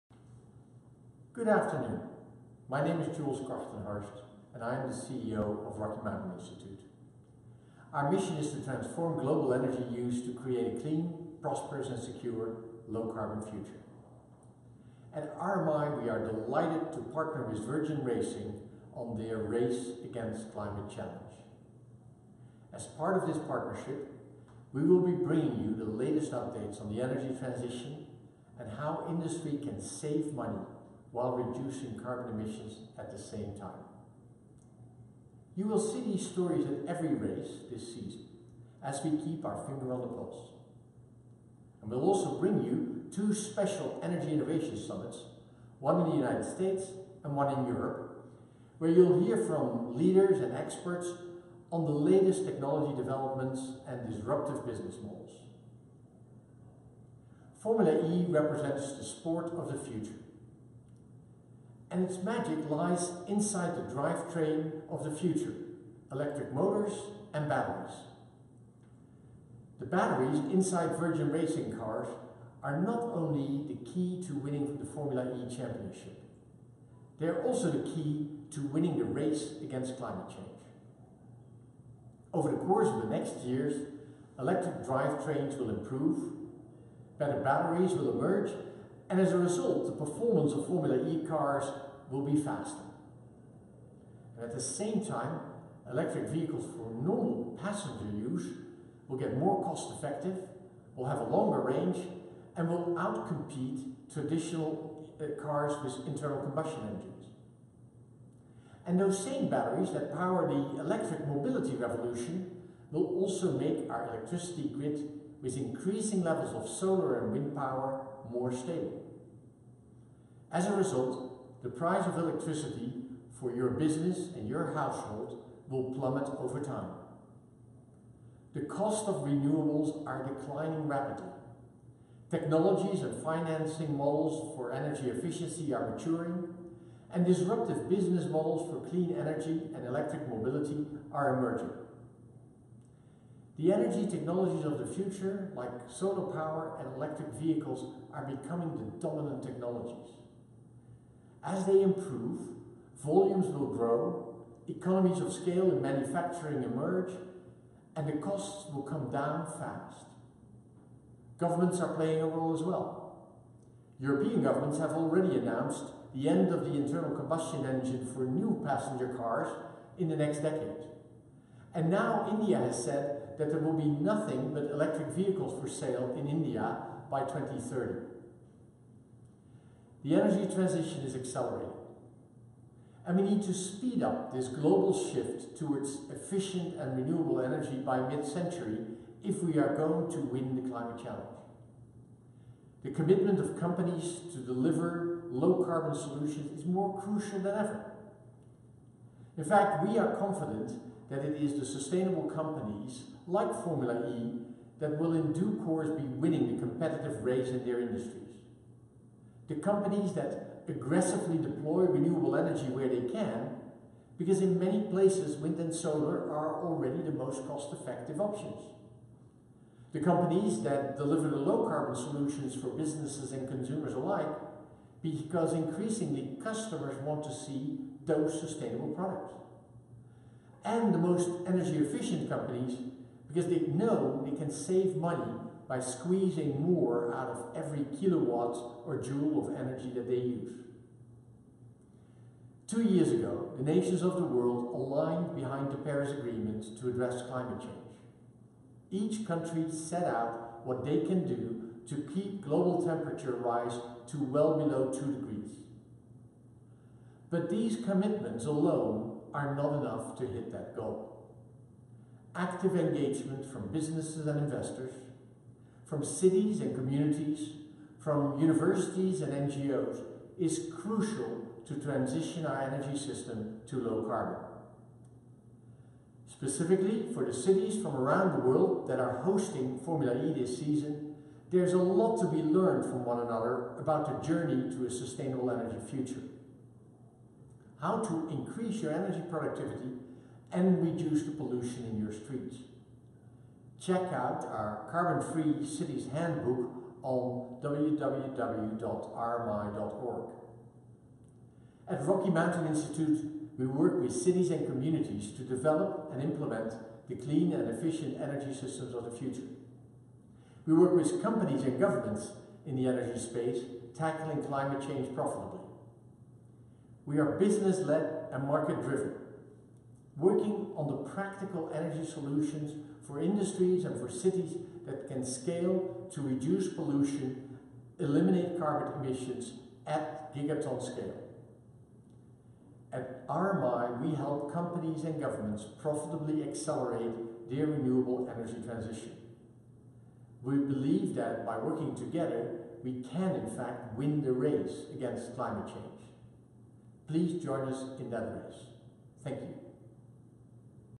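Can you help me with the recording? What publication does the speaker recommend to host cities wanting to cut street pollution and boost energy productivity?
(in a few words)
Carbon Free Cities Handbook.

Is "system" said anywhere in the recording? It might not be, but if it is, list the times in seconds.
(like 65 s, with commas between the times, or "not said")
272 s, 308 s.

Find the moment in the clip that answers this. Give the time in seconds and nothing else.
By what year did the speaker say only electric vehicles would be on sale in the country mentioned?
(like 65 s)
177 s.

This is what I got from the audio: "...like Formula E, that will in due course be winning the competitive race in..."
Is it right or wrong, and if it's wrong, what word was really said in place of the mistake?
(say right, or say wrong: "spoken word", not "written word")
right.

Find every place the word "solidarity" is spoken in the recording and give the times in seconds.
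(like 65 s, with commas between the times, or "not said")
not said.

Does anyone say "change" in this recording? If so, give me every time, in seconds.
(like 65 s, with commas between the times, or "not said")
80 s, 247 s, 314 s, 345 s.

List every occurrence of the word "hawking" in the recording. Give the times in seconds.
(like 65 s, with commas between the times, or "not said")
not said.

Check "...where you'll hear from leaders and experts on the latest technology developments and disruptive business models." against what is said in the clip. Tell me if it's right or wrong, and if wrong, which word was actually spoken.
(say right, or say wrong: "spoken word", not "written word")
right.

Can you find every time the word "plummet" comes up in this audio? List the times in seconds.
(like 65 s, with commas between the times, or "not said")
125 s.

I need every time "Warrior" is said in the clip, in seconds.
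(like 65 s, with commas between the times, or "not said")
not said.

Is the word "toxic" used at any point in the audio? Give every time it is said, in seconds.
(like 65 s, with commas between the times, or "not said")
not said.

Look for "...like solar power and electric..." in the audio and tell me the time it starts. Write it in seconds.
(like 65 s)
145 s.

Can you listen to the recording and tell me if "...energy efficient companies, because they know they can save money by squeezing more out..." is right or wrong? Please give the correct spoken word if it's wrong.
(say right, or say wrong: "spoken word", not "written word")
right.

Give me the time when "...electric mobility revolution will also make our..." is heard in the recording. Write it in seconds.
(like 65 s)
110 s.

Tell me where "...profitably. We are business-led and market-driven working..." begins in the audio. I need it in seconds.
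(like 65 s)
315 s.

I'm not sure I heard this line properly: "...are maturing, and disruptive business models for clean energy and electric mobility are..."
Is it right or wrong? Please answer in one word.
right.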